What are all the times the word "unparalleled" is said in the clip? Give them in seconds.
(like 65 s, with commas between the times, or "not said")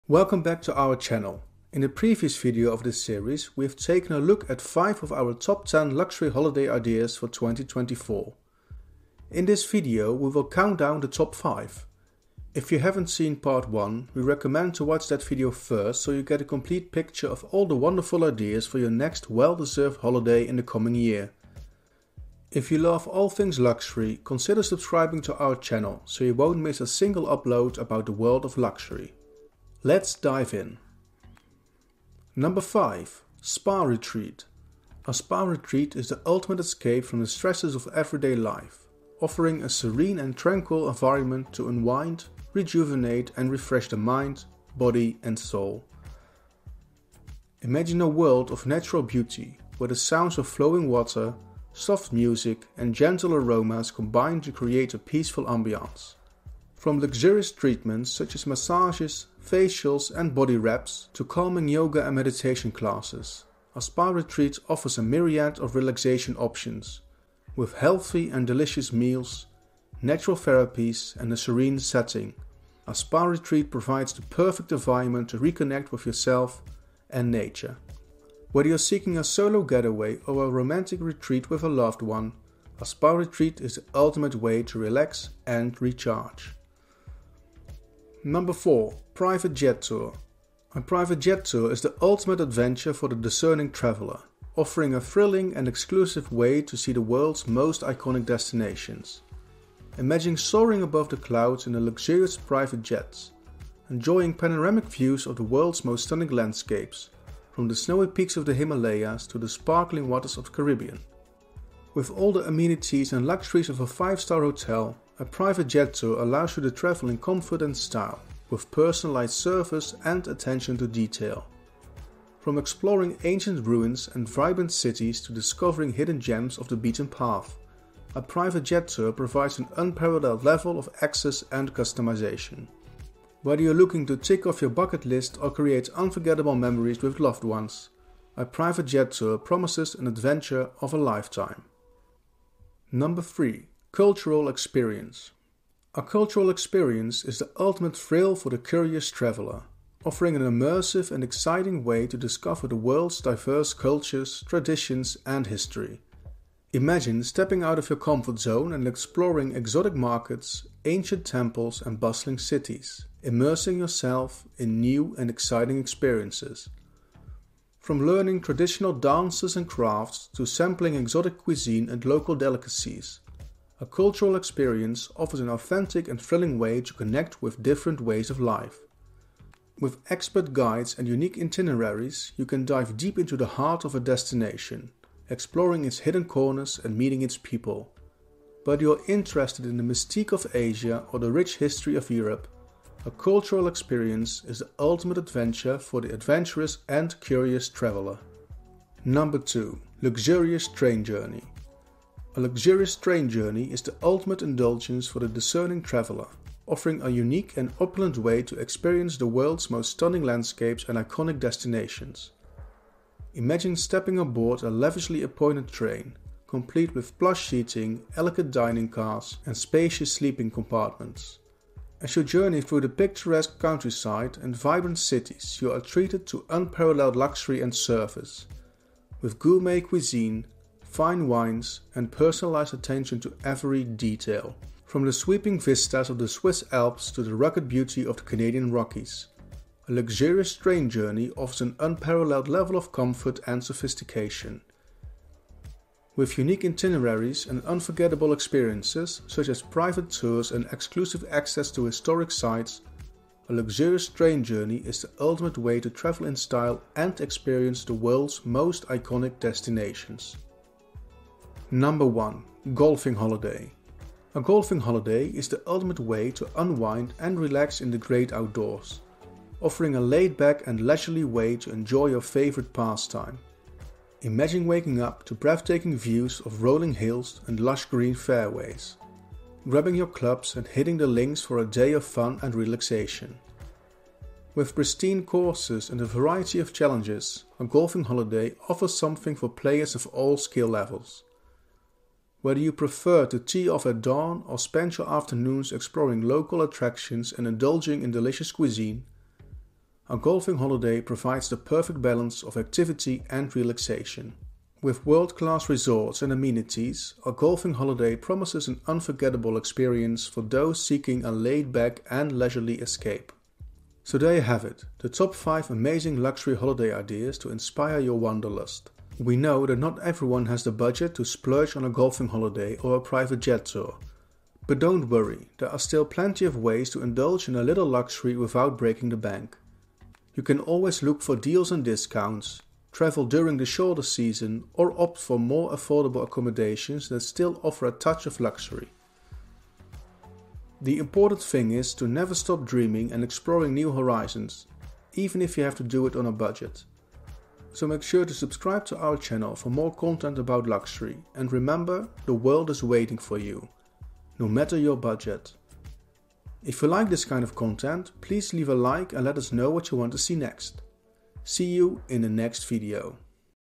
129 s, 226 s, 241 s.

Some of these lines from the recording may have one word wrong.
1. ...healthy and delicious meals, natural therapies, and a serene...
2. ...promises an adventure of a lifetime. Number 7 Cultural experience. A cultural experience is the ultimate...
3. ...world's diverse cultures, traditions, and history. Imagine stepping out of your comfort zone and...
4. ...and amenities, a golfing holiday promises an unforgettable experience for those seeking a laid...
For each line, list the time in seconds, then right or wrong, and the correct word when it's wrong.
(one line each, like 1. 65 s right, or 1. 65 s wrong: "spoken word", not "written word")
1. 67 s right
2. 139 s wrong: "3", not "7"
3. 152 s right
4. 306 s right.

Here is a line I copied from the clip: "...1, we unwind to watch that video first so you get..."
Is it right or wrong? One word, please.
wrong.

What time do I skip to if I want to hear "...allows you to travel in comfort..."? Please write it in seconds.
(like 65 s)
116 s.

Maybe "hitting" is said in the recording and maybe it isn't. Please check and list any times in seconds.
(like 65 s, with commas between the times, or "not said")
280 s.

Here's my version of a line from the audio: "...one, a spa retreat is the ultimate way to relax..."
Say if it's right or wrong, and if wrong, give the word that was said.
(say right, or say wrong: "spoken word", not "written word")
right.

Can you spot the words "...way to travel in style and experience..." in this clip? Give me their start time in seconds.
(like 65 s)
255 s.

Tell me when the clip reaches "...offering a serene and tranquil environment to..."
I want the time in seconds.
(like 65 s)
39 s.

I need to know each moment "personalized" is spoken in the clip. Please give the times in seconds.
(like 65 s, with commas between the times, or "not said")
118 s, 232 s.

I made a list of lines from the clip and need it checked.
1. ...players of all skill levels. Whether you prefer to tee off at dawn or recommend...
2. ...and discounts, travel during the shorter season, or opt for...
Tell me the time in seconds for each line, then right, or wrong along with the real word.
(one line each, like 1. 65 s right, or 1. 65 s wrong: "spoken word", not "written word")
1. 289 s wrong: "spend", not "recommend"
2. 331 s right.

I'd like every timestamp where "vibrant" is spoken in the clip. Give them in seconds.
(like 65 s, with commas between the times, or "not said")
124 s, 224 s.